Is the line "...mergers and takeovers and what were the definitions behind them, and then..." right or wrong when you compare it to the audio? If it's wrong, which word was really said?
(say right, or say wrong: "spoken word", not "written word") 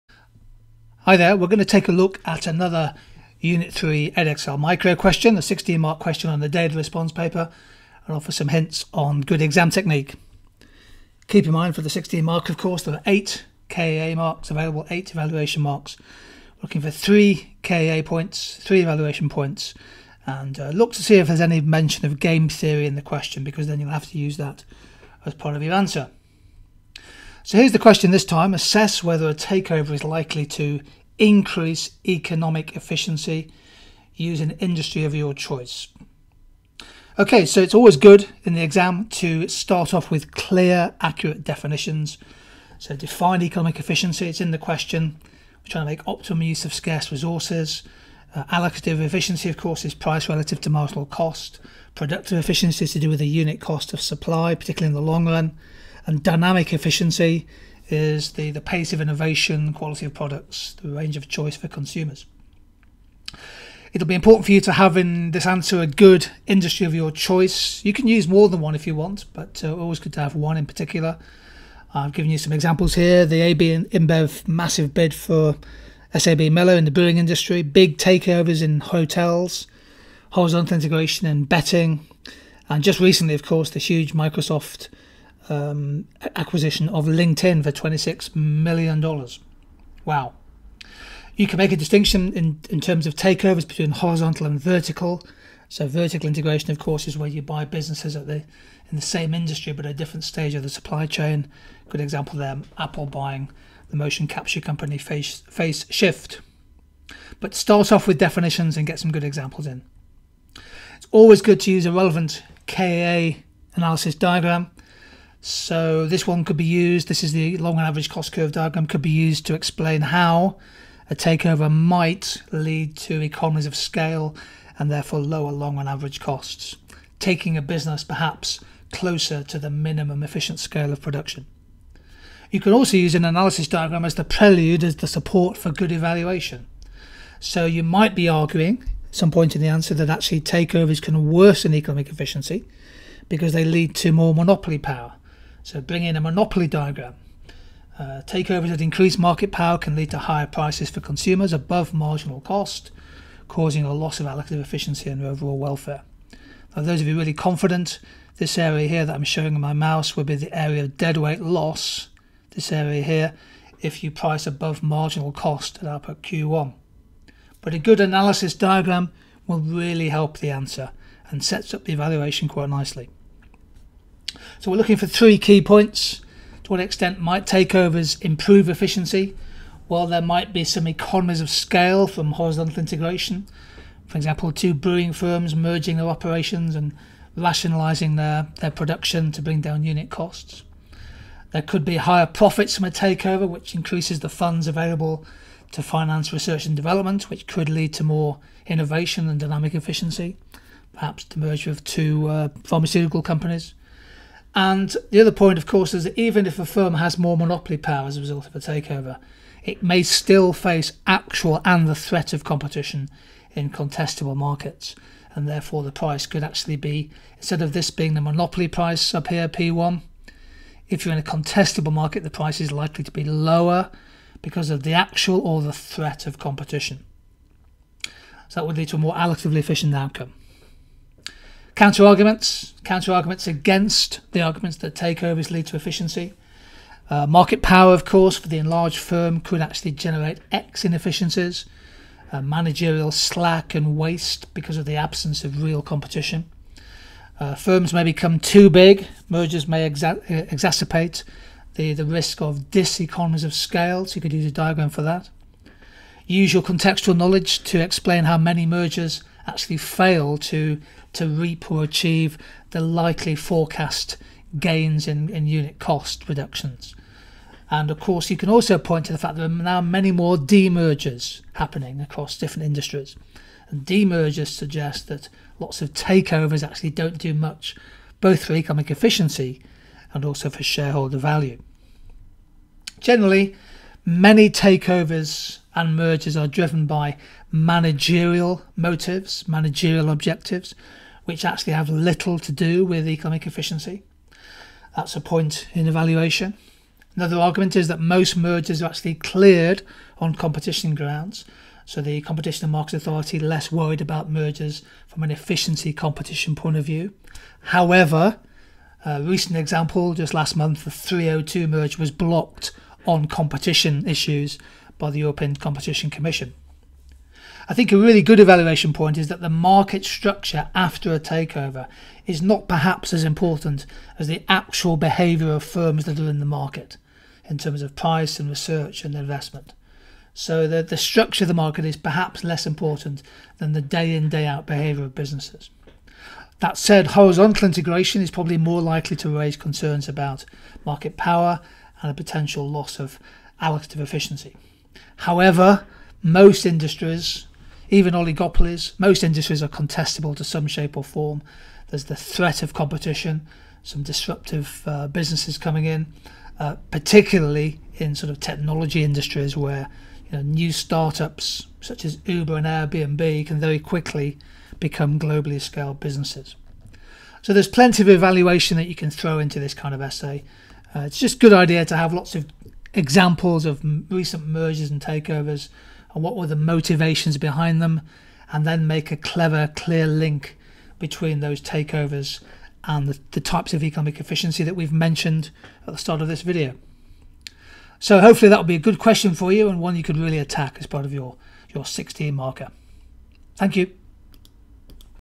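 wrong: "motivations", not "definitions".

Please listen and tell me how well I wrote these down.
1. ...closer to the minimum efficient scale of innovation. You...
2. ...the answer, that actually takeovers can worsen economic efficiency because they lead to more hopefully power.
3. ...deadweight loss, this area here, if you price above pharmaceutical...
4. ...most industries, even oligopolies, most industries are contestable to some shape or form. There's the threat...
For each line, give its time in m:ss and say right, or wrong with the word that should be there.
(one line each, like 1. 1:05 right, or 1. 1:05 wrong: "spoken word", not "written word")
1. 2:08 wrong: "production", not "innovation"
2. 2:19 wrong: "monopoly", not "hopefully"
3. 2:40 wrong: "marginal", not "pharmaceutical"
4. 5:46 right.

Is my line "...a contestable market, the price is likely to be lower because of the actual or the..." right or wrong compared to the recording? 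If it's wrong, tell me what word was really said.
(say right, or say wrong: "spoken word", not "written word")
right.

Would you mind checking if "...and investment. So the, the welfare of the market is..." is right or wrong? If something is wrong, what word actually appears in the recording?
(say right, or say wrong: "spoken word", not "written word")
wrong: "structure", not "welfare".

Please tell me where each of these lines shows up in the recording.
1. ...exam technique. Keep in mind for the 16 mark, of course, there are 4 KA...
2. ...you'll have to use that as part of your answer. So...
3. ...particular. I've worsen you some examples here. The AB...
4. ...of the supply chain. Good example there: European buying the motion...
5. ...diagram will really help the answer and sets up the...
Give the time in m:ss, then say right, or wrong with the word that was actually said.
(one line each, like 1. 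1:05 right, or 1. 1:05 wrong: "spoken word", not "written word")
1. 0:09 wrong: "8", not "4"
2. 0:23 right
3. 1:10 wrong: "given", not "worsen"
4. 1:40 wrong: "Apple", not "European"
5. 2:48 right.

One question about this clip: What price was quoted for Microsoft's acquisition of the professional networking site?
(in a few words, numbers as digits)
$26 million.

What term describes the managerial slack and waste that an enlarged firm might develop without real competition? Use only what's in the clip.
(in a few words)
X inefficiencies.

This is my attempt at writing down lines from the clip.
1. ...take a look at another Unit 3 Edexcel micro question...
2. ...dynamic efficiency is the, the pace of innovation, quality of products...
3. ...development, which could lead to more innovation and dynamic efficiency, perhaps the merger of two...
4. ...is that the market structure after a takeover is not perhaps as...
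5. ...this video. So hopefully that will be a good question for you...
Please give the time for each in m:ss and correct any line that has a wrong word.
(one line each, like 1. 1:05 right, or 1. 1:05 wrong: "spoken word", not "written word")
1. 0:01 right
2. 0:56 right
3. 3:16 right
4. 5:19 right
5. 6:26 right.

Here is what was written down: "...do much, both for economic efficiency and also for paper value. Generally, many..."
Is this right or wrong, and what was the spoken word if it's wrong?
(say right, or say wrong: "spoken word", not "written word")
wrong: "shareholder", not "paper".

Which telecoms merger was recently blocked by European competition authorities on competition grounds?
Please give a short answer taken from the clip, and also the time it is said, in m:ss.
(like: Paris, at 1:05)
Three O2, at 5:10.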